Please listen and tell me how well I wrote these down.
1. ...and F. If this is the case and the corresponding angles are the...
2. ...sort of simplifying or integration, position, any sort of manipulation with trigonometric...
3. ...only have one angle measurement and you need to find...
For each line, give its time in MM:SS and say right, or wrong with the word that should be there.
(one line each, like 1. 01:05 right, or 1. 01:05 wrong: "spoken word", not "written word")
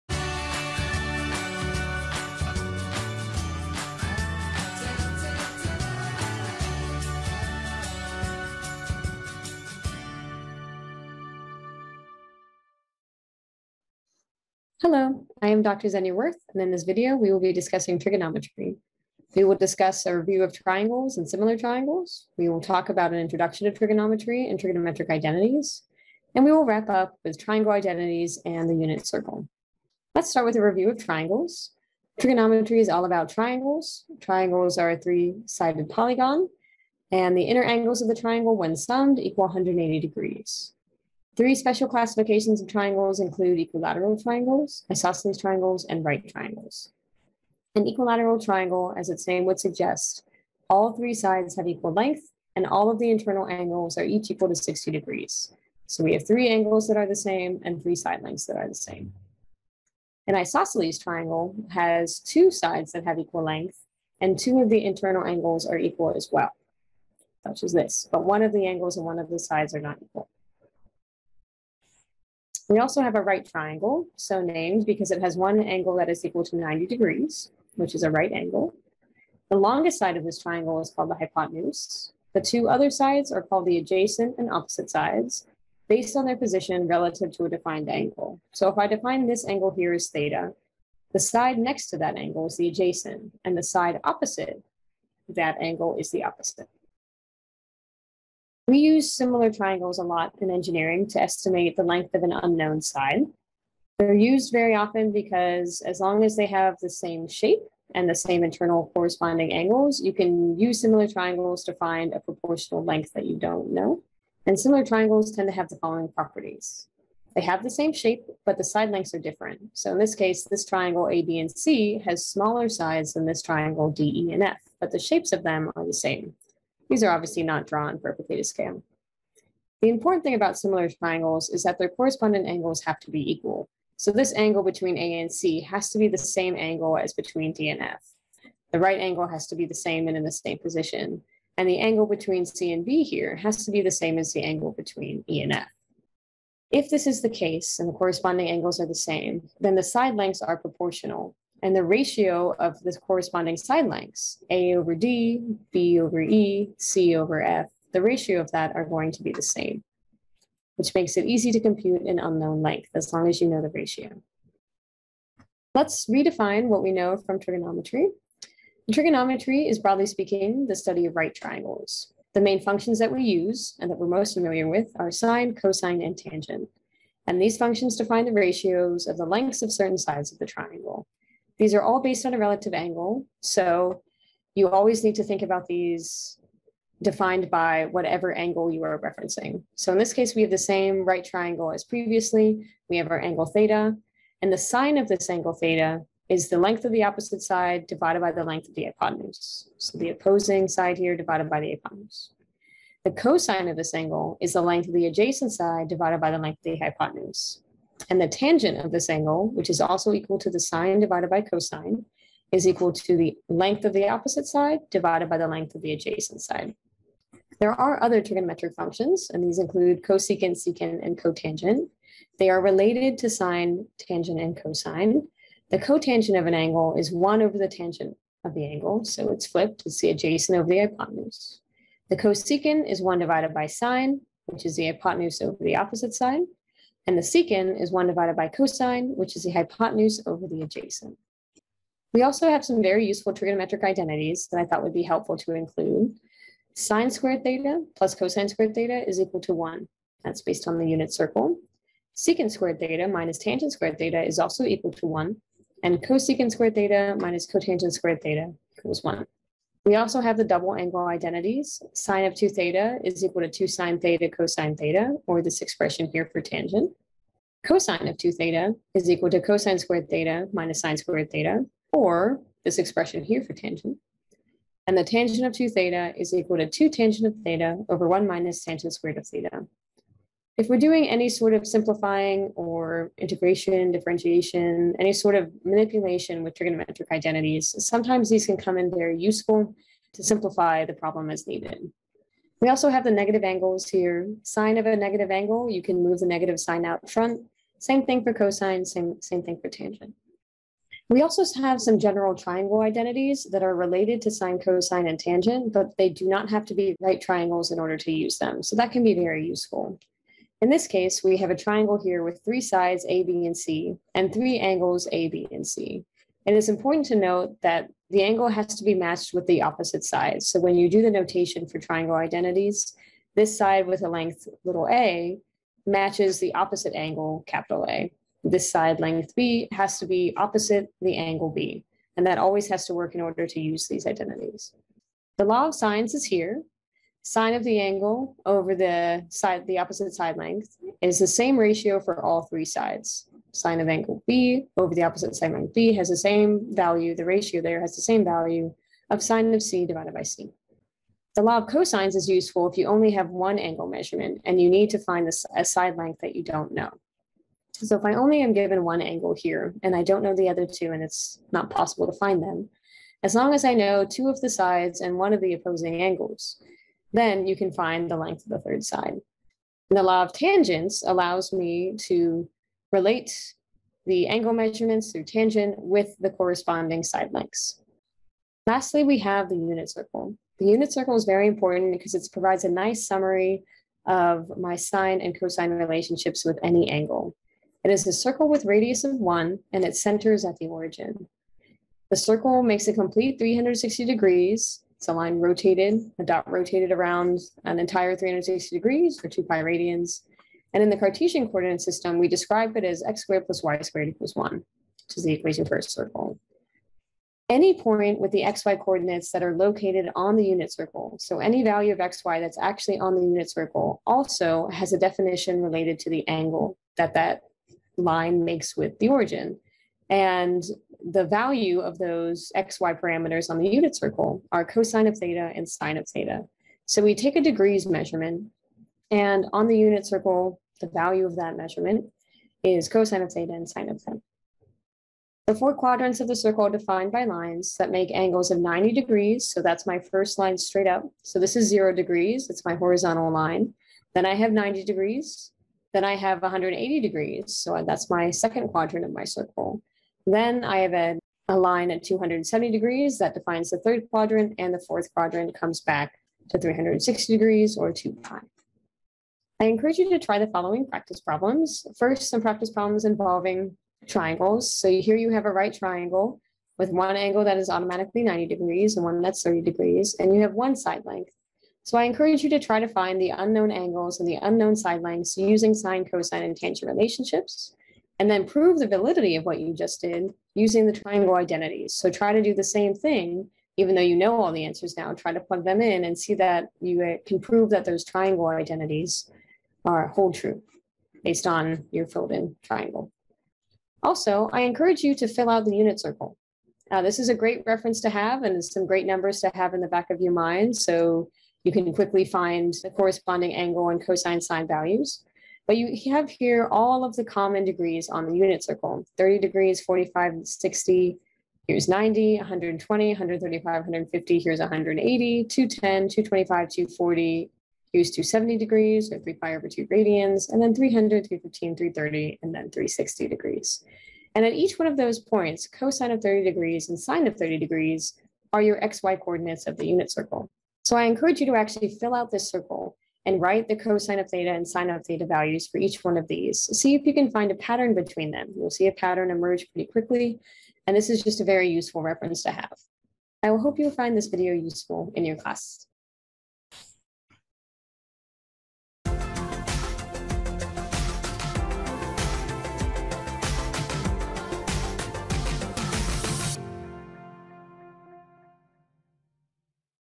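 1. 02:25 right
2. 04:41 wrong: "differentiation", not "position"
3. 05:52 right.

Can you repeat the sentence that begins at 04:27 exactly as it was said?
Cosine of 2 theta is equal to cosine squared theta minus sine squared theta, or this expression here for tangent.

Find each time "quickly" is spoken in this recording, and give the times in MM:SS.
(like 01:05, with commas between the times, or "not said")
08:21, 08:59.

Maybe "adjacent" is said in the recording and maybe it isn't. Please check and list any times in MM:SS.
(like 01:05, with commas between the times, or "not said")
01:23, 01:32, 03:25, 03:35, 03:50, 04:00.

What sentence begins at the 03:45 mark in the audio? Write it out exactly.
The cotangent of an angle is 1 over the tangent of the angle, so it's flipped.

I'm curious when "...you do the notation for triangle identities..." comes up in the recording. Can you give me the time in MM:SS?
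05:20.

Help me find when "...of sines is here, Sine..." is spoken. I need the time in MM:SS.
05:35.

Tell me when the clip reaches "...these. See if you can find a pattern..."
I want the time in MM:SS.
08:56.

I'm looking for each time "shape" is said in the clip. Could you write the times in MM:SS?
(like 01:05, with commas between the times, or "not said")
01:47, 01:57, 02:04.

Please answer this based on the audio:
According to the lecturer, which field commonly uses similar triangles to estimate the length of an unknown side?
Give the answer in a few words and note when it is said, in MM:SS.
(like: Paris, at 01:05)
engineering, at 01:40.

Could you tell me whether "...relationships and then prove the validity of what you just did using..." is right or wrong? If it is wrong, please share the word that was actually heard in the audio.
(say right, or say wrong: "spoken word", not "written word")
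right.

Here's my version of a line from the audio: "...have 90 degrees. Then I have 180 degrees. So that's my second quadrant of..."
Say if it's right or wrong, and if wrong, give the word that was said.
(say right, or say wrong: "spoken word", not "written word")
right.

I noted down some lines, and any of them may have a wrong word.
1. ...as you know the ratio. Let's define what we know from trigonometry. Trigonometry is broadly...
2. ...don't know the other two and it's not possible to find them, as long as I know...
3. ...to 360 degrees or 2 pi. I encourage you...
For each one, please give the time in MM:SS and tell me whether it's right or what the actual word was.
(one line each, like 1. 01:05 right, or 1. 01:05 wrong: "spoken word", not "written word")
1. 02:43 wrong: "redefine", not "define"
2. 06:00 right
3. 07:36 right.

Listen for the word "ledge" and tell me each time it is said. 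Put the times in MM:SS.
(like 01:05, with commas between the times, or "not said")
not said.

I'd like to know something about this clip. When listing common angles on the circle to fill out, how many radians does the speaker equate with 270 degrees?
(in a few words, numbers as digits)
3 pi over 2.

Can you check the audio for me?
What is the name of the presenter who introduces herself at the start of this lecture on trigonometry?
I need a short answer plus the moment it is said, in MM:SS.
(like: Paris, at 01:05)
Zenia Worth, at 00:15.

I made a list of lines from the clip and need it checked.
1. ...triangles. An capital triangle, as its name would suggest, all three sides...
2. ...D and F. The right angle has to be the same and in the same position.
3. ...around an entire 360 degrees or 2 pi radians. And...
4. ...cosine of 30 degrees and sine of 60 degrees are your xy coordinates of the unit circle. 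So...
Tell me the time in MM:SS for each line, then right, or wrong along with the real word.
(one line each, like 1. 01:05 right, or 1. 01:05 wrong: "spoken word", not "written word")
1. 00:46 wrong: "equilateral", not "capital"
2. 02:17 right
3. 06:36 right
4. 08:45 wrong: "30", not "60".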